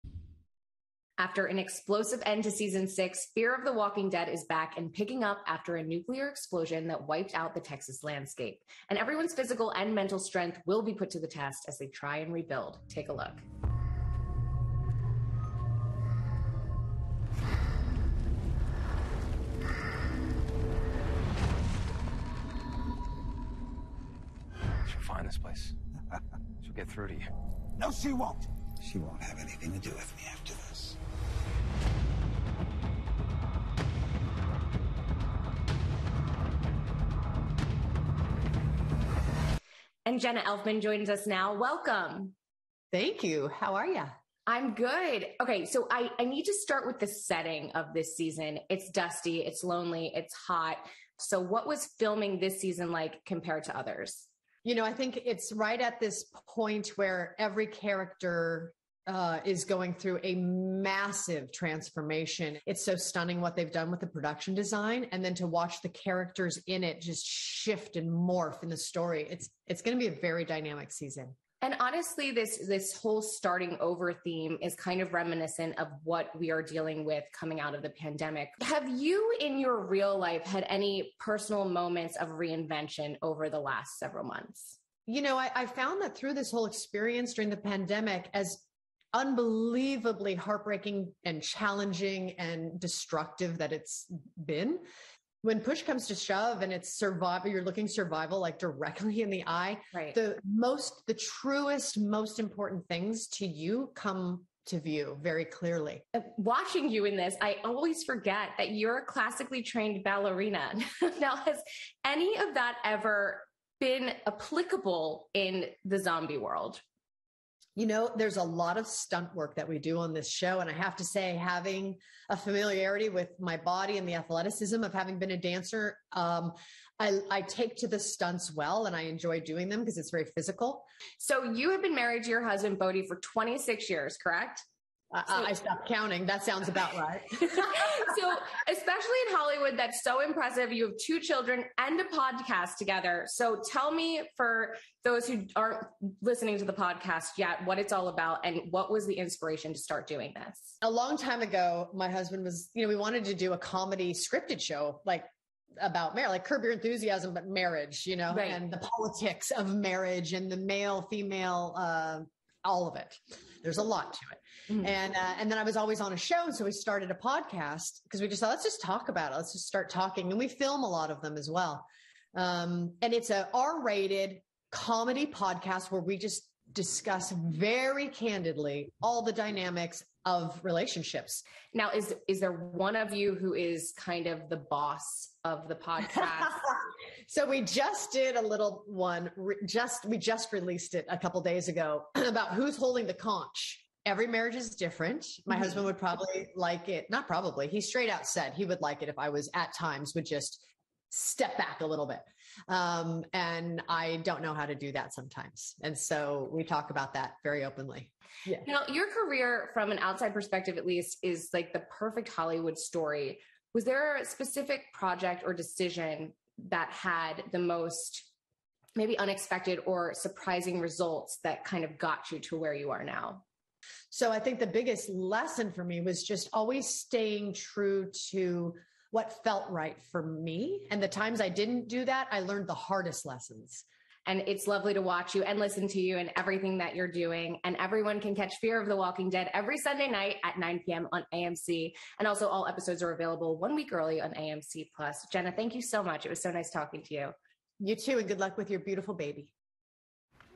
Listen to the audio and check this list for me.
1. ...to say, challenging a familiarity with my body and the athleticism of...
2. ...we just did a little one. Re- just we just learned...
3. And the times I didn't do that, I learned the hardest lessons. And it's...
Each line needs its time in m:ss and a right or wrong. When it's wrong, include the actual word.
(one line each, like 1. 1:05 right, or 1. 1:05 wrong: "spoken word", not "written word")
1. 2:00 wrong: "having", not "challenging"
2. 3:07 wrong: "released", not "learned"
3. 3:50 right.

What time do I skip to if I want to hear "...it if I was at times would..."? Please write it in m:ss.
3:19.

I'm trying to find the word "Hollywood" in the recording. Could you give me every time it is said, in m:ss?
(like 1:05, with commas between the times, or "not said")
2:19, 3:32.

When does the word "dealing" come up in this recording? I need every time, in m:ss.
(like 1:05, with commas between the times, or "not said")
1:16.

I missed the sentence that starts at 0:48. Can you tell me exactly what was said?
It's dusty, it's lonely, it's hot.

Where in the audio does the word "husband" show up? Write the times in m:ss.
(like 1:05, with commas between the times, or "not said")
2:12, 2:32, 3:15.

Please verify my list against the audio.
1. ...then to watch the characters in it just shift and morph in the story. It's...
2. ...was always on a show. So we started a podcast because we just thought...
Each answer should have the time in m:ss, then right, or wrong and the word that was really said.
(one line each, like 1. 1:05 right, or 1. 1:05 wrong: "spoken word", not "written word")
1. 1:05 right
2. 2:45 right.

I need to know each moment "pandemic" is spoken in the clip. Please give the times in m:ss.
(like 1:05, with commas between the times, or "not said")
1:17, 1:27.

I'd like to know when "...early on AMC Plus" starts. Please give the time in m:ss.
4:03.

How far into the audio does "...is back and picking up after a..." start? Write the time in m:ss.
0:04.